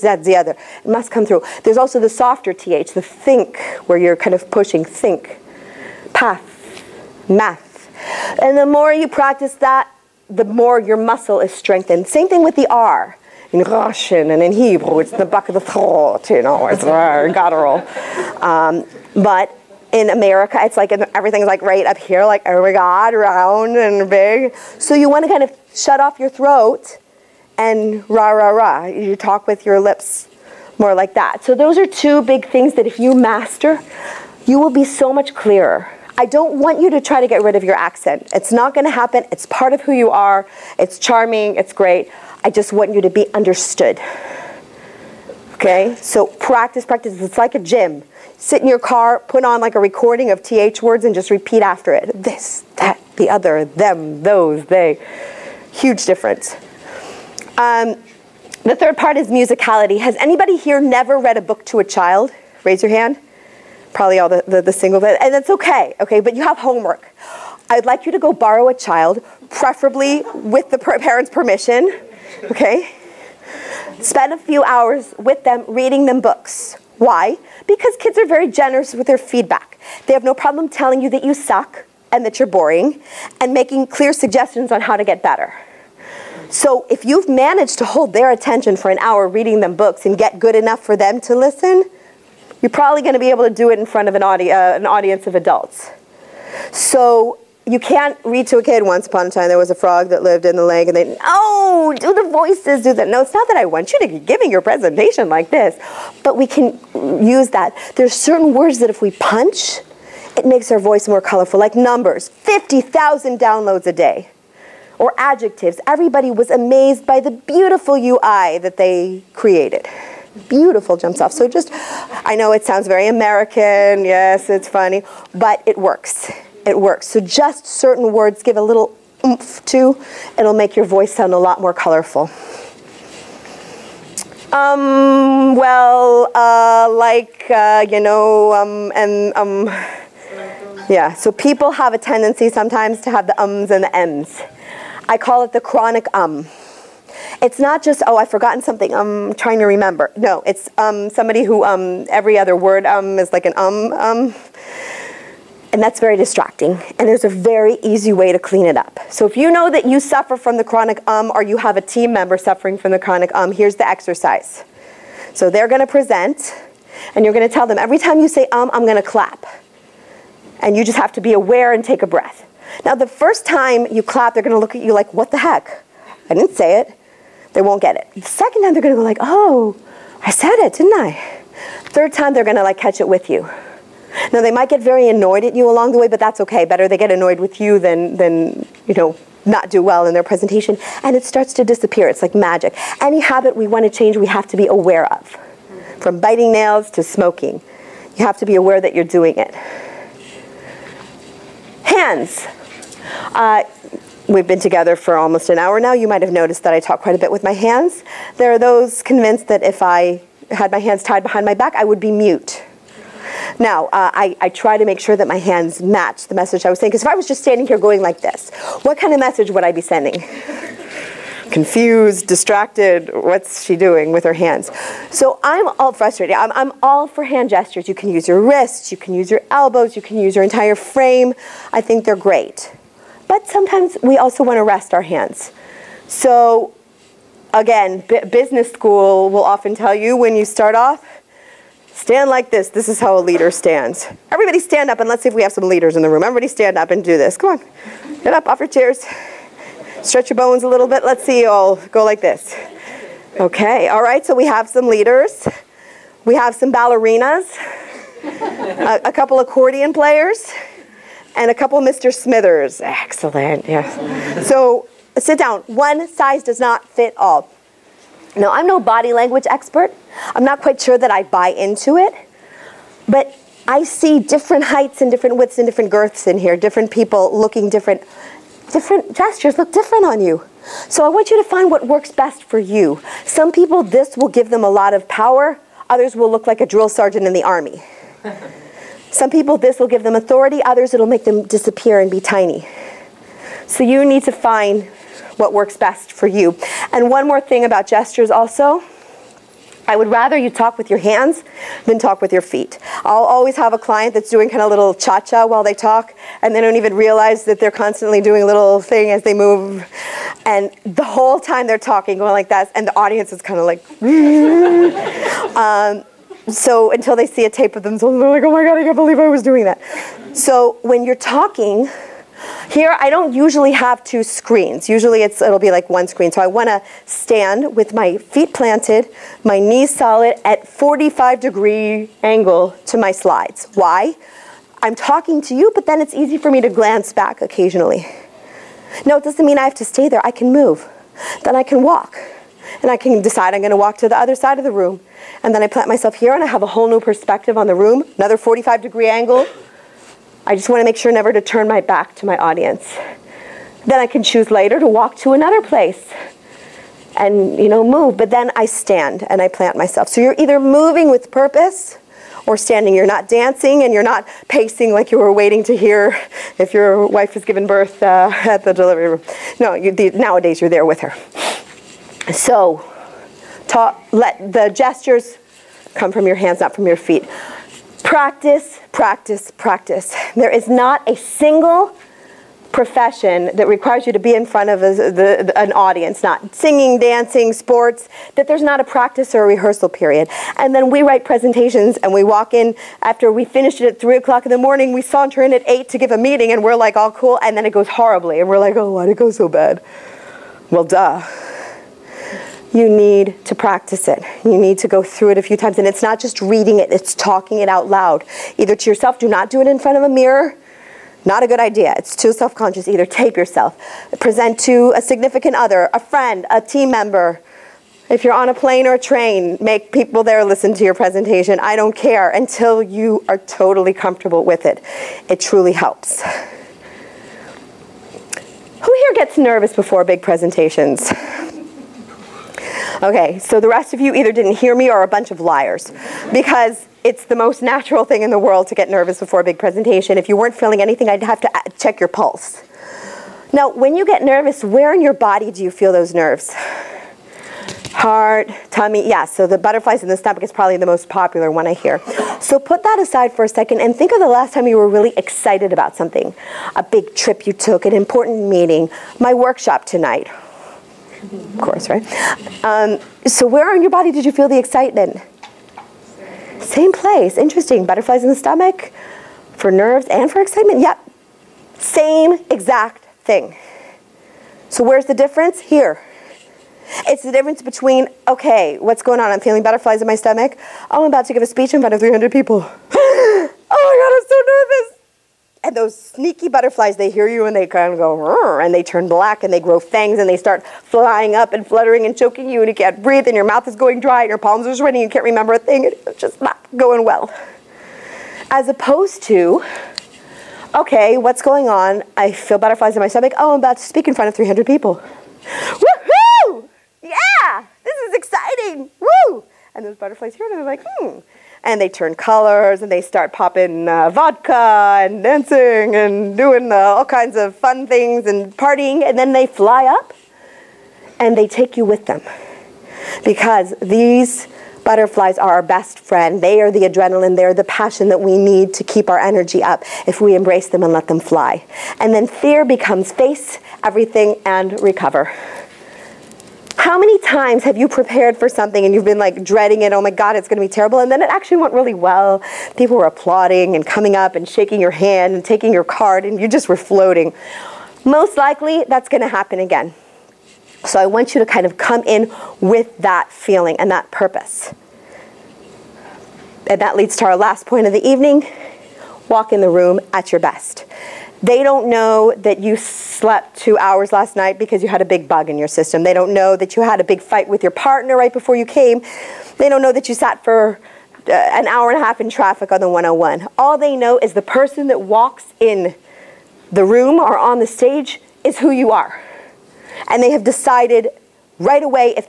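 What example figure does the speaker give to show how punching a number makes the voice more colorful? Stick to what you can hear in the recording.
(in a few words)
50,000 downloads a day.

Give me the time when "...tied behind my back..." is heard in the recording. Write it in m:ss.
3:31.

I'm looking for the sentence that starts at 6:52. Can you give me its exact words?
Either tape yourself, present to a significant other, a friend, a team member.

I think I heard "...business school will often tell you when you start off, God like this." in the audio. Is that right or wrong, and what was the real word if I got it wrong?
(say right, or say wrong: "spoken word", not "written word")
wrong: "Stand", not "God".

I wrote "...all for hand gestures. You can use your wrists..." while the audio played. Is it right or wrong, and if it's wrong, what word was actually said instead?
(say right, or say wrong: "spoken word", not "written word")
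right.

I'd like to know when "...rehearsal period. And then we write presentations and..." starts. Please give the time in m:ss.
6:29.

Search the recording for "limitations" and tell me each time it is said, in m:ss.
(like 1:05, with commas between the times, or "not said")
not said.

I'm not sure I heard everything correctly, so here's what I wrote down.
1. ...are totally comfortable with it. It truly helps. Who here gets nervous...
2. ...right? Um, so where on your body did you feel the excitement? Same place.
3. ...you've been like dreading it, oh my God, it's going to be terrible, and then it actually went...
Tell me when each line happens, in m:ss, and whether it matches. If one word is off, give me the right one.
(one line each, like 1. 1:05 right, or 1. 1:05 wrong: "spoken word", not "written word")
1. 7:03 right
2. 7:41 right
3. 8:58 right.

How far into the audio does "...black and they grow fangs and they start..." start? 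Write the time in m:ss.
8:09.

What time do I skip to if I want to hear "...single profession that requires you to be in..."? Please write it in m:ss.
6:21.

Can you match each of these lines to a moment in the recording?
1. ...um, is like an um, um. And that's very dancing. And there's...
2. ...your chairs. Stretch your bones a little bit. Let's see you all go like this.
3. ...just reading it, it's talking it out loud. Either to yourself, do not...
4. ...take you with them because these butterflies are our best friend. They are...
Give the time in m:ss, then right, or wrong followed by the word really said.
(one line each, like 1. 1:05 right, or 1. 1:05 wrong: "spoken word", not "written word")
1. 2:32 wrong: "distracting", not "dancing"
2. 4:08 right
3. 6:46 right
4. 8:41 right.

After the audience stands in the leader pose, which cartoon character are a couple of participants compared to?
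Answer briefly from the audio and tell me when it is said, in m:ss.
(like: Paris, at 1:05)
Mr. Smithers, at 4:21.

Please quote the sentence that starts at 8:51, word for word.
And then fear becomes face, everything, and recover.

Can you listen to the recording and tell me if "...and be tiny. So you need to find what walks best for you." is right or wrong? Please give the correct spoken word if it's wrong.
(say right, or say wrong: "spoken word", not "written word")
wrong: "works", not "walks".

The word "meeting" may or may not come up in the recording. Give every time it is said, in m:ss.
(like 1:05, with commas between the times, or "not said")
6:36, 7:38.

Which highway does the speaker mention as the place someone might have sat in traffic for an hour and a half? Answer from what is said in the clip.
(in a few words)
the 101.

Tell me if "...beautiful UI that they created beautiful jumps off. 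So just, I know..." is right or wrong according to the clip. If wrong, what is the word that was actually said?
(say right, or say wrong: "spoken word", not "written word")
right.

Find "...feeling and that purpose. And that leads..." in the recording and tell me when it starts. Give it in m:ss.
9:13.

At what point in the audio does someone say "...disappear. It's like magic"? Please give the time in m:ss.
3:11.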